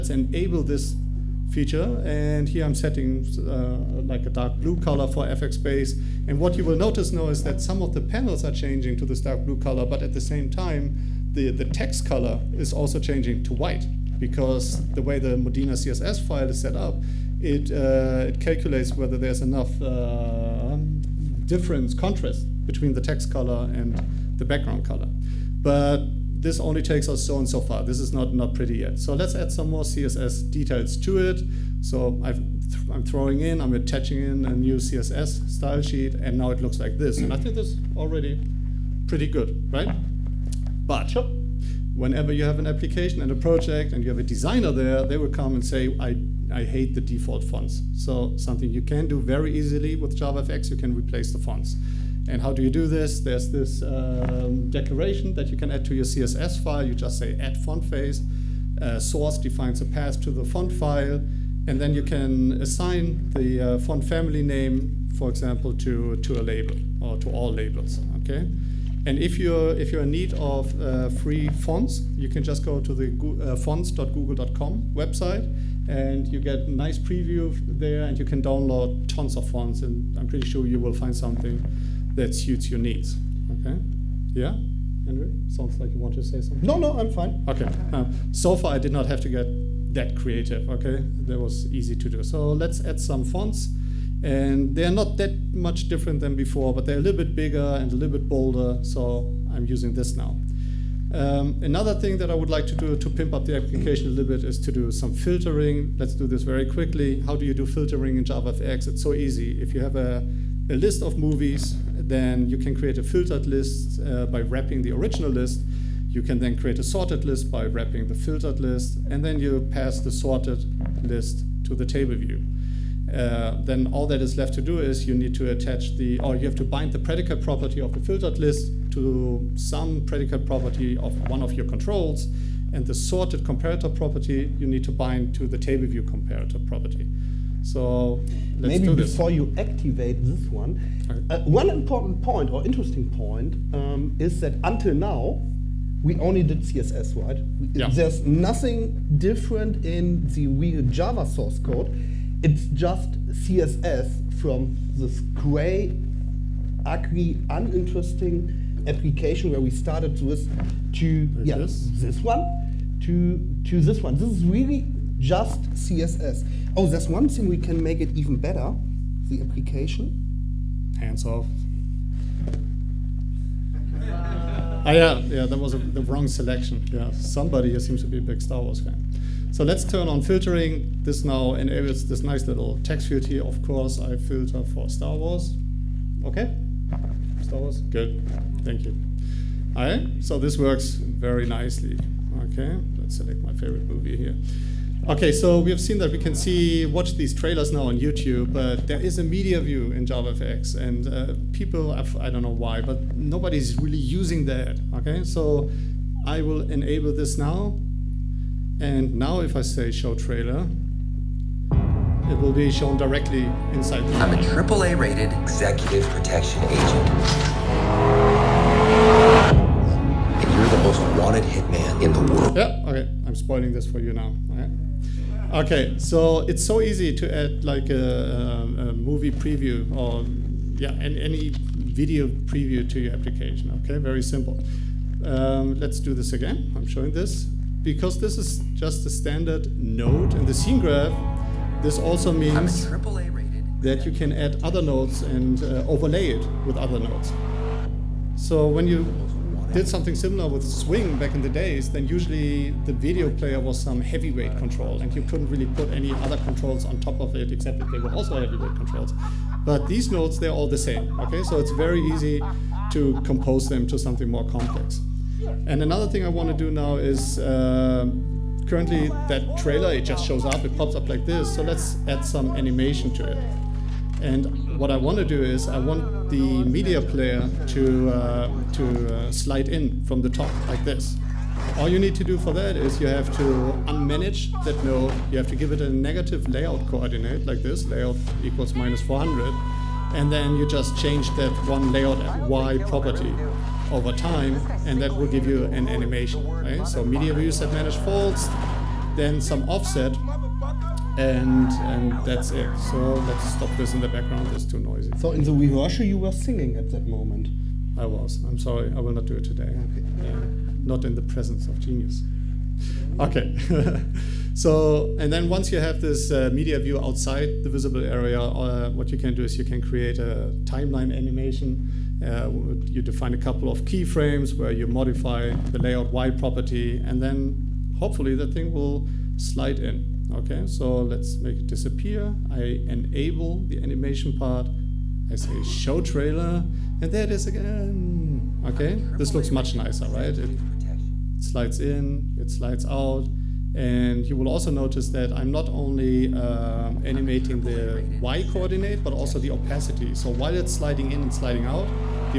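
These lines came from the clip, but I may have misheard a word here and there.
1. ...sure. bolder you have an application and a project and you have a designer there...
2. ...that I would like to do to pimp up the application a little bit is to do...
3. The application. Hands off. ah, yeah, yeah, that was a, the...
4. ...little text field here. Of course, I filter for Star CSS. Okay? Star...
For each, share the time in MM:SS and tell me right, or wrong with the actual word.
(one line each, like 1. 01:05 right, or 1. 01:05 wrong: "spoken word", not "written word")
1. 00:41 wrong: "whenever", not "bolder"
2. 01:42 right
3. 02:49 right
4. 03:02 wrong: "Wars", not "CSS".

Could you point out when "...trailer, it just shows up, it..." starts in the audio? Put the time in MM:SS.
04:29.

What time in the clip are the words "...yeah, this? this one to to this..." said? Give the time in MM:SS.
02:41.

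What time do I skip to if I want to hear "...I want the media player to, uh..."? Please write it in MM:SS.
04:35.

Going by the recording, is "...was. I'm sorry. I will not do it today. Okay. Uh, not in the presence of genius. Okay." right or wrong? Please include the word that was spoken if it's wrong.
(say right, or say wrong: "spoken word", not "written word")
right.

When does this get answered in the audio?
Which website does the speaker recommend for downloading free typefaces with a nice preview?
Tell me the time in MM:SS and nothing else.
01:13.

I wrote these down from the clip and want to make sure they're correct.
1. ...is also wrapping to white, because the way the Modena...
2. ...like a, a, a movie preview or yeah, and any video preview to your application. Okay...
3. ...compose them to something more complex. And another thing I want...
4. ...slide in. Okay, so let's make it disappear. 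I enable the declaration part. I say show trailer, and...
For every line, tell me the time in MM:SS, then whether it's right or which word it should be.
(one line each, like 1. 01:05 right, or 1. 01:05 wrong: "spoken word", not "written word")
1. 00:12 wrong: "changing", not "wrapping"
2. 03:47 right
3. 04:23 right
4. 05:29 wrong: "animation", not "declaration".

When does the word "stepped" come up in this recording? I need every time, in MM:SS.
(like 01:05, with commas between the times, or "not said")
not said.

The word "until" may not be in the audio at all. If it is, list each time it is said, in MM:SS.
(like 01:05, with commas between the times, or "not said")
02:24.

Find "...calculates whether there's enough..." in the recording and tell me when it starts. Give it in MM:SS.
00:18.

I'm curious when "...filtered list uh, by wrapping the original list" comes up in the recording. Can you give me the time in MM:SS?
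01:53.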